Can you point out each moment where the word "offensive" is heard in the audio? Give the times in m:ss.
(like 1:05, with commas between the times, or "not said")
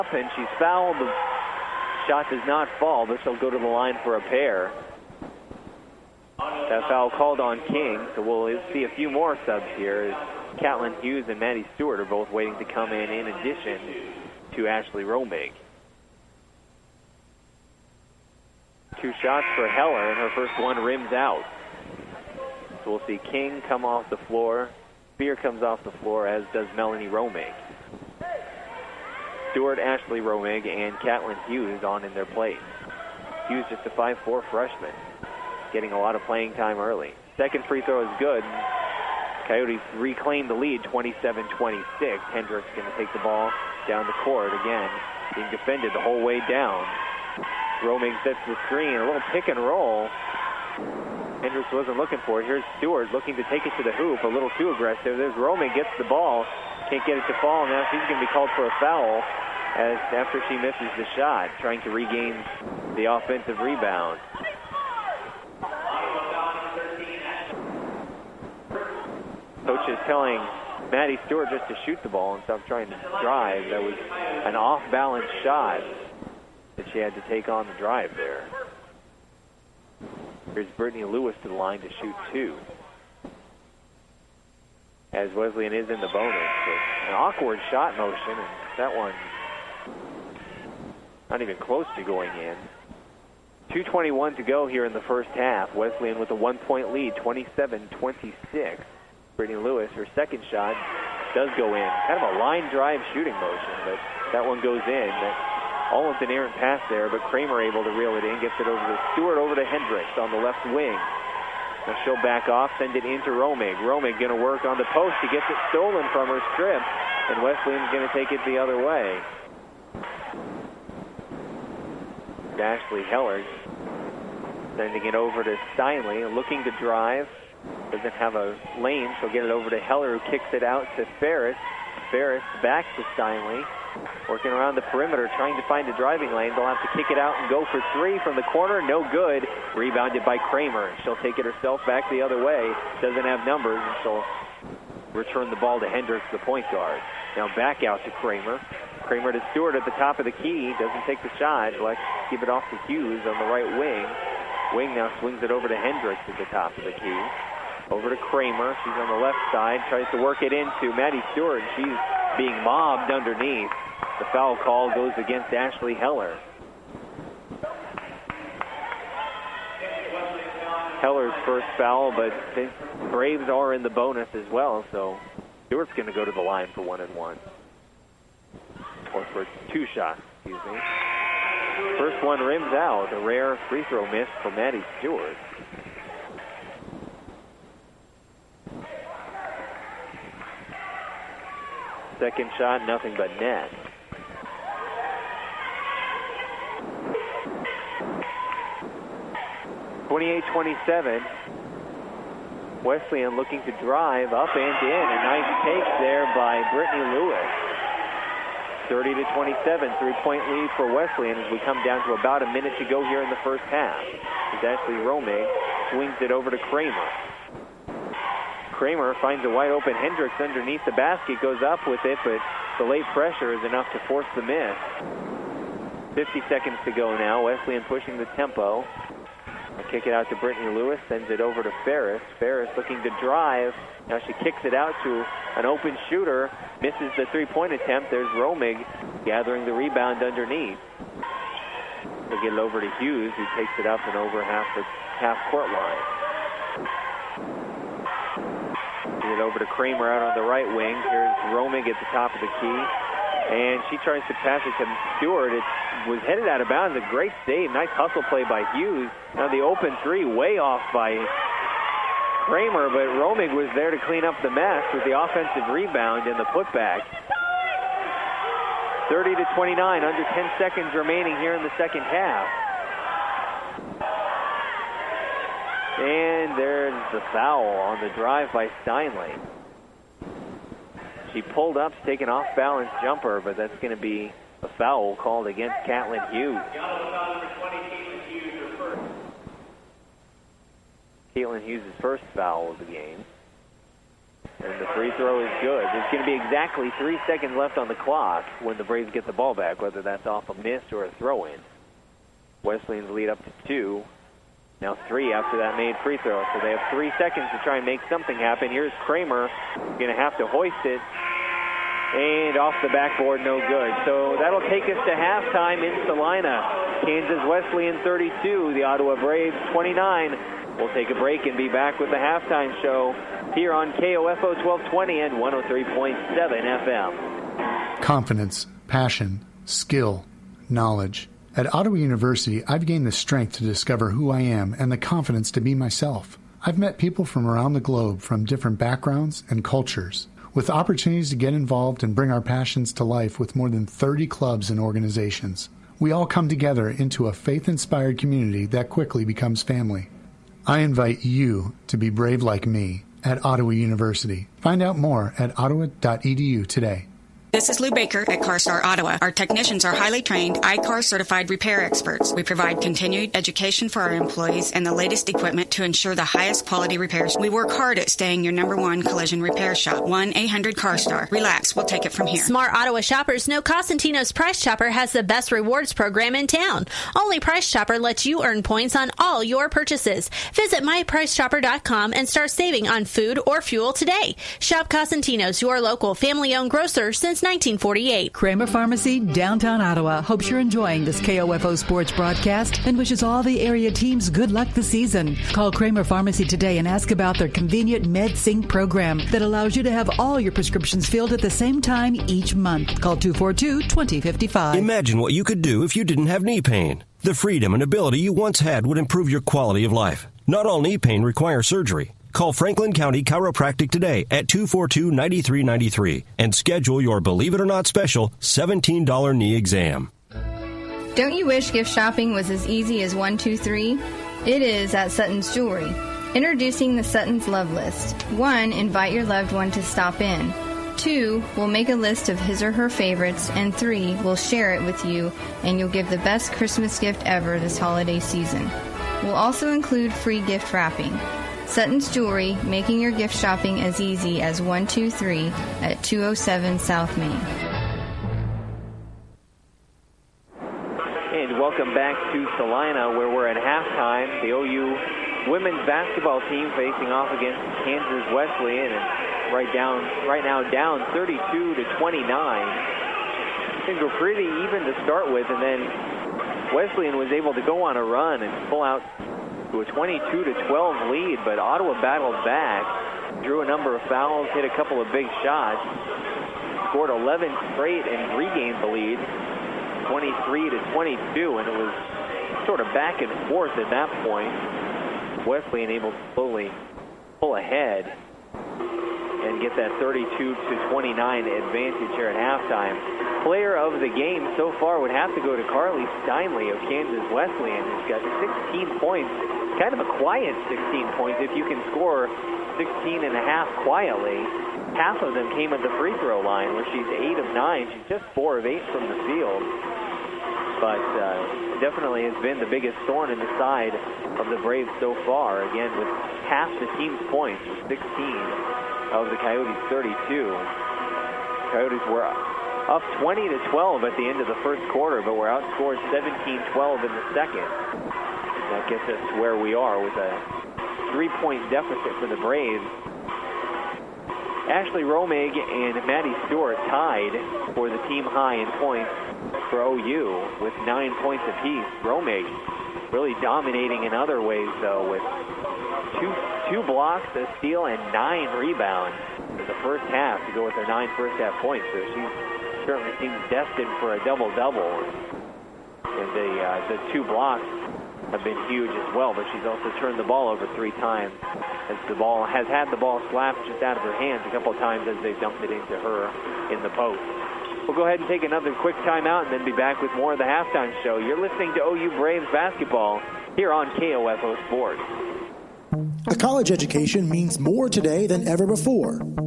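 1:03, 4:25.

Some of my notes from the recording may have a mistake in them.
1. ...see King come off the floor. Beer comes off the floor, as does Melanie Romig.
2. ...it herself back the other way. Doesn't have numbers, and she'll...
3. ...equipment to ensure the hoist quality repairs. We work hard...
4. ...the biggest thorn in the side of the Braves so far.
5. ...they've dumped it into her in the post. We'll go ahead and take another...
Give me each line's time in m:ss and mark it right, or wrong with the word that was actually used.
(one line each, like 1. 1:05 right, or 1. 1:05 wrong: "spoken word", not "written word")
1. 0:23 right
2. 2:21 right
3. 6:05 wrong: "highest", not "hoist"
4. 8:32 right
5. 9:25 right.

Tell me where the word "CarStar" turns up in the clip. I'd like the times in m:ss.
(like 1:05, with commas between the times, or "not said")
5:58, 6:10.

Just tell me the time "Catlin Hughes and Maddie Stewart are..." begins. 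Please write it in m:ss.
0:10.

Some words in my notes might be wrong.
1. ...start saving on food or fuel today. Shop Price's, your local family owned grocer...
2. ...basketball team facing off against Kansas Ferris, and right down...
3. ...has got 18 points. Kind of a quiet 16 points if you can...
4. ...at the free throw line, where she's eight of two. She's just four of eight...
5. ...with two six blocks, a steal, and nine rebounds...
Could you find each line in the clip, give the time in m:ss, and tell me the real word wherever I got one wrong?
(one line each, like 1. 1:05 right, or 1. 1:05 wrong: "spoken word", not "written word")
1. 6:22 wrong: "Costantino", not "Price"
2. 7:35 wrong: "Wesleyan", not "Ferris"
3. 8:18 wrong: "16", not "18"
4. 8:25 wrong: "nine", not "two"
5. 9:05 wrong: "two", not "six".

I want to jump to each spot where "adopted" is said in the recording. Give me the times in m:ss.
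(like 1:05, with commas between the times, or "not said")
not said.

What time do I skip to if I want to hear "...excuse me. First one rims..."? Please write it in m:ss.
3:00.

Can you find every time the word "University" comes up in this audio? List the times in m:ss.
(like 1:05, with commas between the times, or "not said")
5:31, 5:53.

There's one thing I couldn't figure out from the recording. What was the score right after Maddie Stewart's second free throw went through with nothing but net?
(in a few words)
28-27.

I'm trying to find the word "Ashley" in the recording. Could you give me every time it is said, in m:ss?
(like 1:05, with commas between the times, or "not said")
0:14, 0:29, 2:02, 2:45, 3:34, 8:54.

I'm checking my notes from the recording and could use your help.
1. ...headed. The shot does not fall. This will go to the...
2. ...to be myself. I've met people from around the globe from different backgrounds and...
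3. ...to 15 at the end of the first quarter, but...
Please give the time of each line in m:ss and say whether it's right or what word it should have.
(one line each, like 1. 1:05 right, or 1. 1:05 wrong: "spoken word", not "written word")
1. 0:00 wrong: "fouled", not "headed"
2. 5:35 right
3. 8:43 wrong: "12", not "15".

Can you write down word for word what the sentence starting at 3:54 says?
Now she kicks it out to an open shooter, misses the three point attempt.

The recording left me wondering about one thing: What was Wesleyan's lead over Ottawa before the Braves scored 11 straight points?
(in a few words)
22 to 12.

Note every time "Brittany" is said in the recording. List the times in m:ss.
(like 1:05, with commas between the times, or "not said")
1:20, 1:39, 3:26, 3:50.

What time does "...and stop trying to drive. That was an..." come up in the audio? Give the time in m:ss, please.
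1:12.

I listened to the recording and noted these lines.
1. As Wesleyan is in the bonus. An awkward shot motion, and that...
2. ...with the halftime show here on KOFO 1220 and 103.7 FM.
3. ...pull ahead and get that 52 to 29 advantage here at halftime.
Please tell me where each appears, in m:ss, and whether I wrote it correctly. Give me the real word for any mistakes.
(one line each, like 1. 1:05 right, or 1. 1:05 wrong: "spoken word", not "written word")
1. 1:25 right
2. 5:21 right
3. 8:07 wrong: "32", not "52".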